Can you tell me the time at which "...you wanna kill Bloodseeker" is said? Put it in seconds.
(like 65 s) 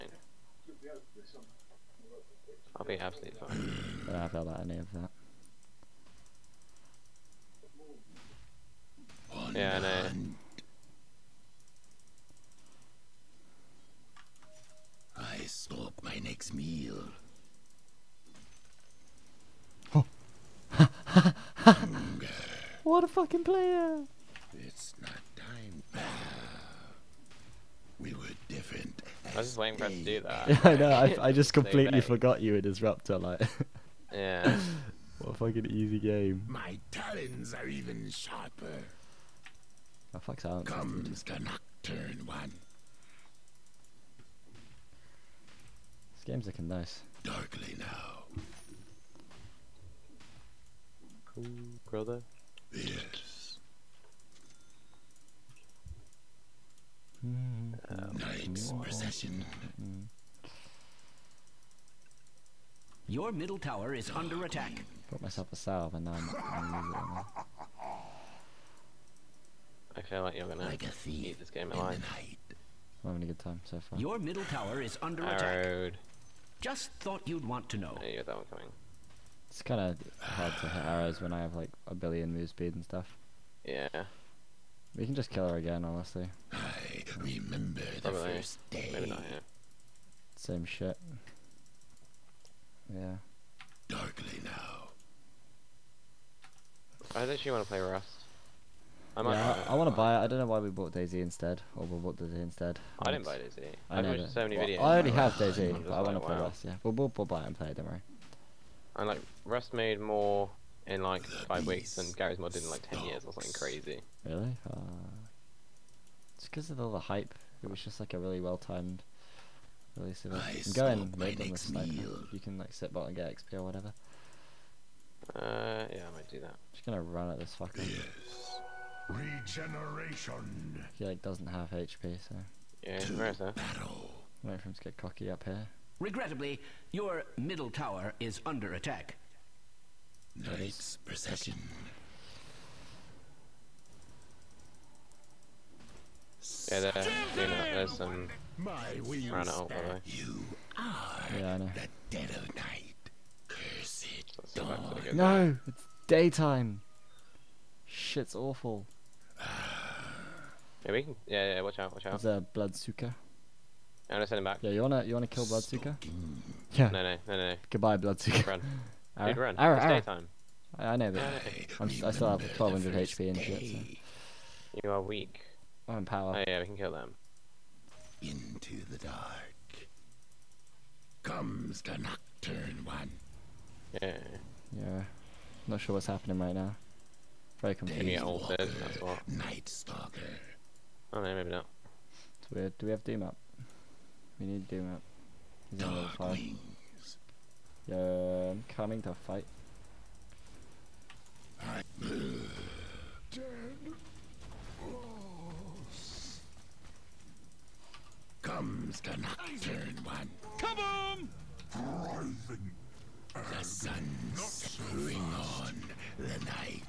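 165 s.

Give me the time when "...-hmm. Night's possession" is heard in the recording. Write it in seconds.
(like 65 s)
57 s.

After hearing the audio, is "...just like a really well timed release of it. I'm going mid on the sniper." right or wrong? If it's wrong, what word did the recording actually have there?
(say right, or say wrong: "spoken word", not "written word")
right.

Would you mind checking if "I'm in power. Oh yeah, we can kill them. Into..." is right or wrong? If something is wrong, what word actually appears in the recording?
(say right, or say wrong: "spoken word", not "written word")
right.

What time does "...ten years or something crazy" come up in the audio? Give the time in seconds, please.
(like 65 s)
112 s.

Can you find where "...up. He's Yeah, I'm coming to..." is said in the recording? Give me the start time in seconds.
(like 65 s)
194 s.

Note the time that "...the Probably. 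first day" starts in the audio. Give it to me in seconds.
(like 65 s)
88 s.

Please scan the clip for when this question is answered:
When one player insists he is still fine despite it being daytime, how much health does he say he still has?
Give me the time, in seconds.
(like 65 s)
172 s.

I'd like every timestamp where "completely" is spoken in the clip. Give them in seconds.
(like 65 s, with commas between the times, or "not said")
31 s.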